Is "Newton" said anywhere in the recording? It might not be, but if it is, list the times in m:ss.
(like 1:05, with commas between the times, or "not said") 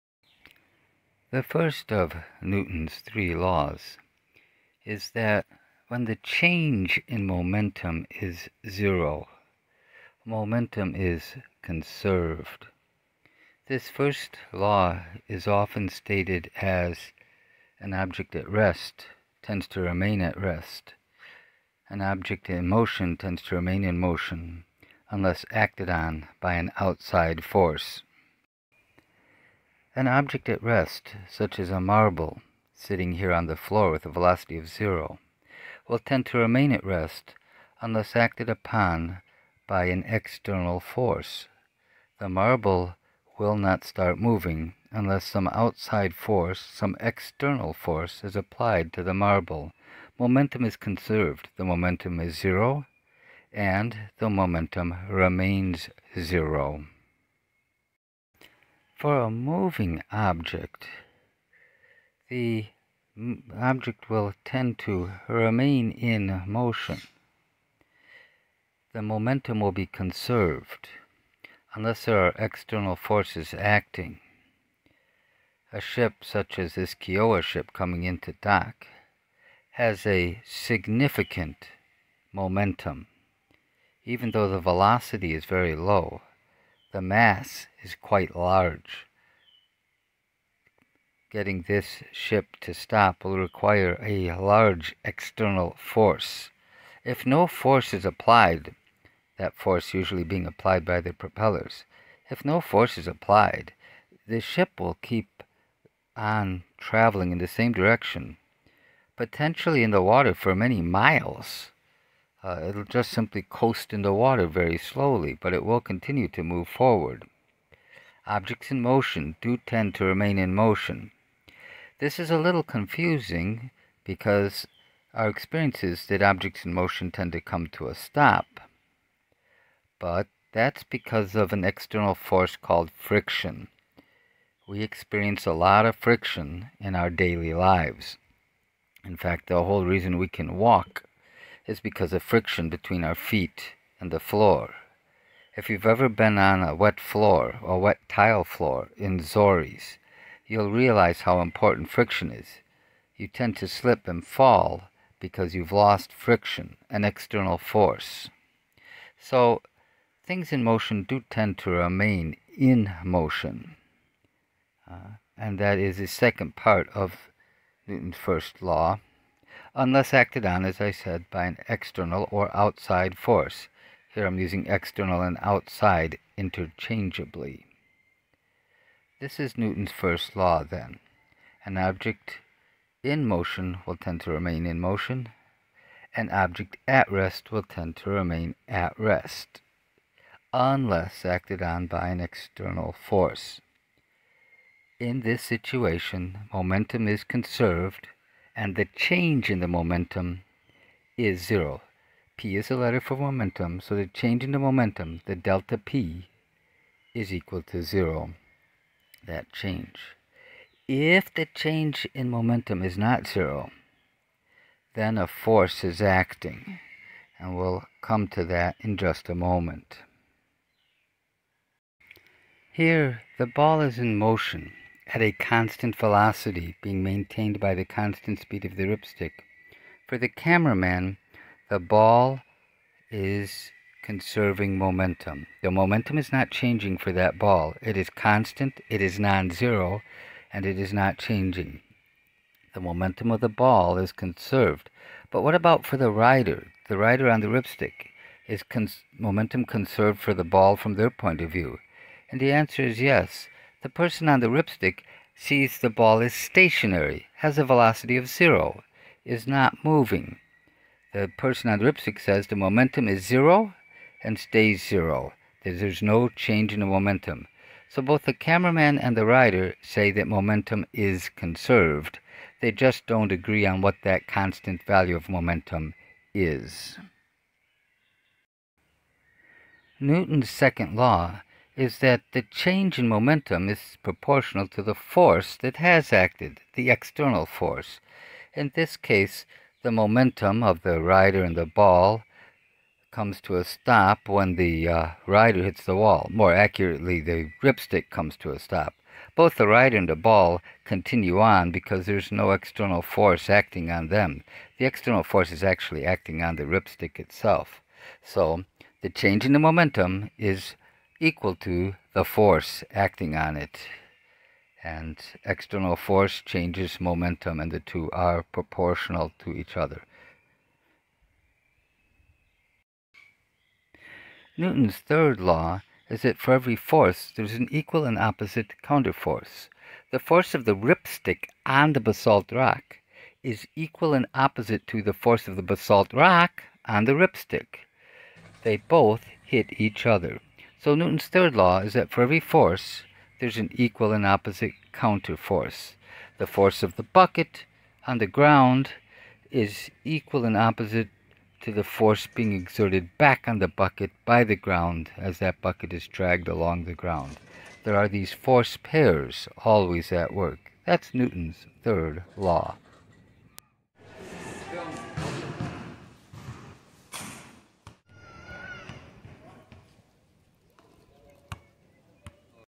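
0:02, 2:47, 2:59, 4:39, 5:24, 5:40, 6:01.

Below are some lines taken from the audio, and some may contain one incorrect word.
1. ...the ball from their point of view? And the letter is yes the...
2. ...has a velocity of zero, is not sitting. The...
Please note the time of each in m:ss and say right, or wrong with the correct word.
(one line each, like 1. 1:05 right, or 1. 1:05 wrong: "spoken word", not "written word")
1. 4:10 wrong: "answer", not "letter"
2. 4:17 wrong: "moving", not "sitting".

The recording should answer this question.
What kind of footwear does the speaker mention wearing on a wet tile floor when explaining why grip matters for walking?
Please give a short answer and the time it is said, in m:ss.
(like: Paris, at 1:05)
Zoris, at 2:29.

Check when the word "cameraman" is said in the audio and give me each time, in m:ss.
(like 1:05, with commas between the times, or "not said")
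3:50, 4:28.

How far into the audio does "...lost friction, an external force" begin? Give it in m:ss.
2:35.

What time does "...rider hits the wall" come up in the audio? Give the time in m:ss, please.
4:55.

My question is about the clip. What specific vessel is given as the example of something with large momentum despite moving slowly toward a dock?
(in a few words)
Kiowa ship.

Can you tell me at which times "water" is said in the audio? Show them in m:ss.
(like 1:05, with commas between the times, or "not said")
1:50, 1:54.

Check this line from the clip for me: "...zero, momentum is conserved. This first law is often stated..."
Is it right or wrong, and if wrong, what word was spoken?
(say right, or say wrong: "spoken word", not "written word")
right.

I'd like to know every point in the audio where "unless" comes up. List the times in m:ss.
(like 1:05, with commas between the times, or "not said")
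0:25, 0:37, 0:44, 1:11, 2:49, 3:10.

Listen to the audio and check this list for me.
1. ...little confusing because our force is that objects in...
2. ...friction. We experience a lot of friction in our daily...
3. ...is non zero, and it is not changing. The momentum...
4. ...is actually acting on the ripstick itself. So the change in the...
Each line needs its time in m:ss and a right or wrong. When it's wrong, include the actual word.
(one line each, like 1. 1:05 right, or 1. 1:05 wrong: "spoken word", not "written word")
1. 2:02 wrong: "experience", not "force"
2. 2:12 right
3. 3:59 right
4. 5:05 right.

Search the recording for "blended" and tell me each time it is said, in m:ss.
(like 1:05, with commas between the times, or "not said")
not said.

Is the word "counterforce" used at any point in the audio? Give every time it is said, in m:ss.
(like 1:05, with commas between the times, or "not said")
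5:28, 5:44.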